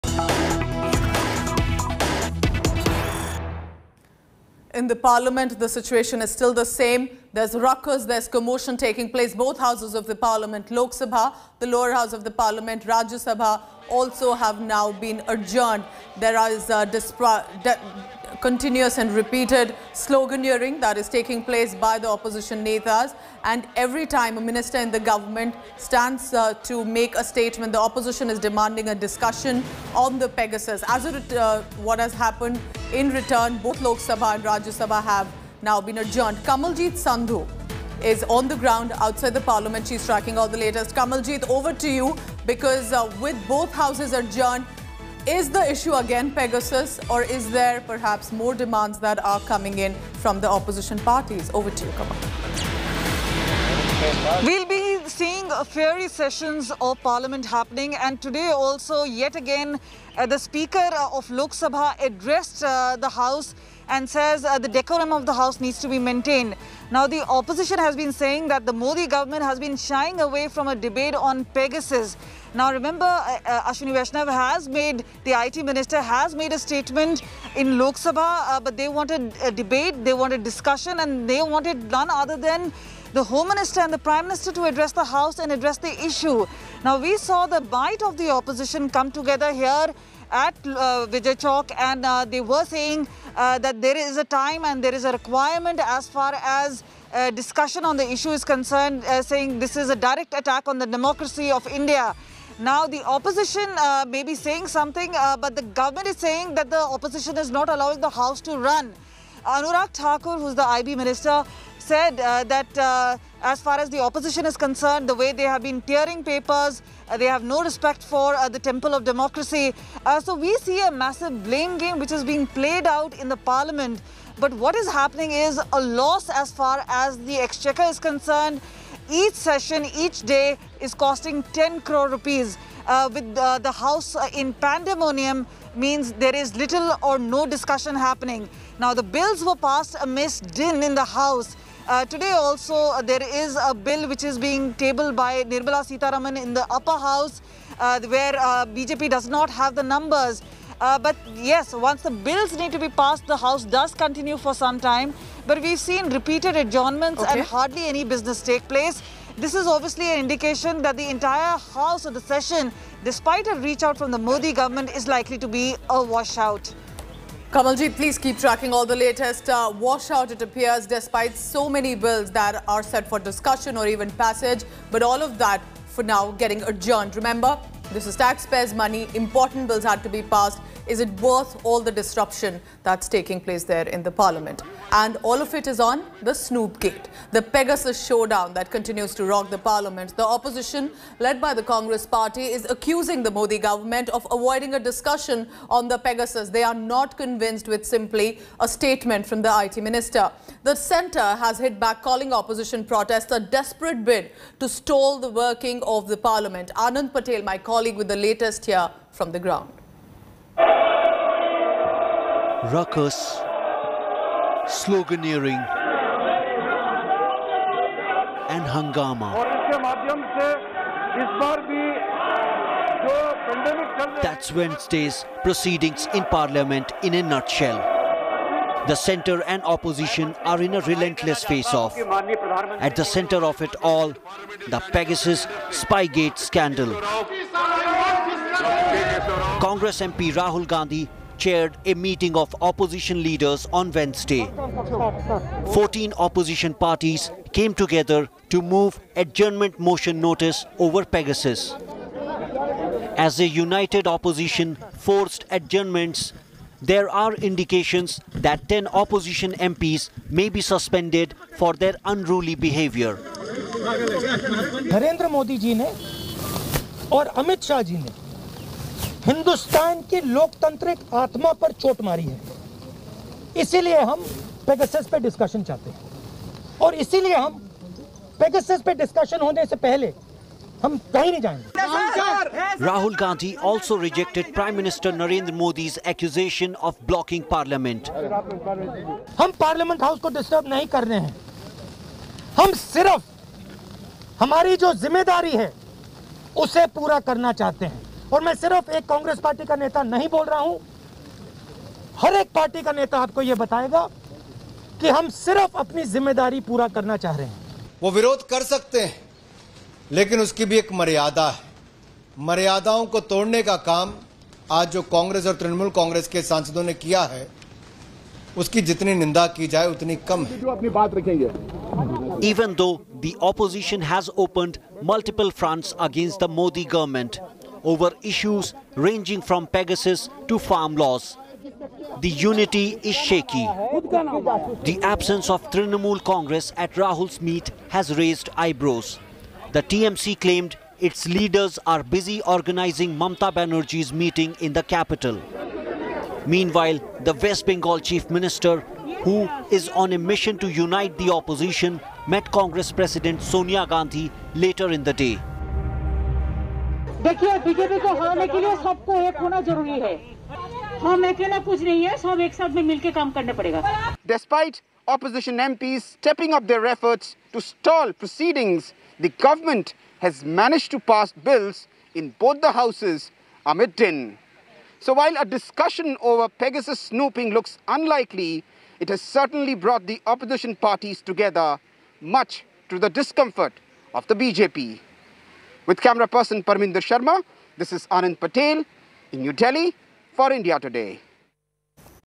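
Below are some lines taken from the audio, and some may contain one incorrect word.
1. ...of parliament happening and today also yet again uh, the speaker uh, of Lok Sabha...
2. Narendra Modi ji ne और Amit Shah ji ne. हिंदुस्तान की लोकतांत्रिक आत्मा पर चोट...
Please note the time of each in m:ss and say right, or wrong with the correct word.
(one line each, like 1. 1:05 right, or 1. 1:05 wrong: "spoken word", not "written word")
1. 0:56 right
2. 4:24 right.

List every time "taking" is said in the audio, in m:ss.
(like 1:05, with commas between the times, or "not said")
0:08, 0:21, 3:03.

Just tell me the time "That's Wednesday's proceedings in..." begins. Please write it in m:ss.
3:44.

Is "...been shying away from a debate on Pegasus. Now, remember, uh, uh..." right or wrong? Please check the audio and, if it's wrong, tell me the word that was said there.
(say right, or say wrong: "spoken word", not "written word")
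right.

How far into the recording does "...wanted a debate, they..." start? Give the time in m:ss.
1:18.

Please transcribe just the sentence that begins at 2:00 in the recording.
so we see a massive blame game which is being played out in the parliament.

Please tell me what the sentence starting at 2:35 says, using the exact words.
But we've seen repeated adjournments okay.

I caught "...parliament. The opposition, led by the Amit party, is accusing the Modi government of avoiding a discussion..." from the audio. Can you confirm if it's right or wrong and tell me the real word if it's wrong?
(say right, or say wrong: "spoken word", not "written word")
wrong: "Congress", not "Amit".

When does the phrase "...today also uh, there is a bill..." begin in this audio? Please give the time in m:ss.
2:22.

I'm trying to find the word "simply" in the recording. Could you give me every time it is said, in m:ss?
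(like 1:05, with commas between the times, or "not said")
3:17.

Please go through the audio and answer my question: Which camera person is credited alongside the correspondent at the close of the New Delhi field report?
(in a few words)
Parminder Sharma.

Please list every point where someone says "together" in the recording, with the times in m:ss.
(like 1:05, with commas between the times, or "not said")
1:29, 4:07, 6:21.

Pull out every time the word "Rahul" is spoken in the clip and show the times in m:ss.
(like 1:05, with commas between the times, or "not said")
4:00, 5:36.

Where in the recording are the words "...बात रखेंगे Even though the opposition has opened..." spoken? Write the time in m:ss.
5:20.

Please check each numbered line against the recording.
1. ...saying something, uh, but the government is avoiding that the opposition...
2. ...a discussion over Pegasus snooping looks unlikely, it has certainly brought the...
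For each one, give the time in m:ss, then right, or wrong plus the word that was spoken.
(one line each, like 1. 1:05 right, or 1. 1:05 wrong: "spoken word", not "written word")
1. 1:44 wrong: "saying", not "avoiding"
2. 6:15 right.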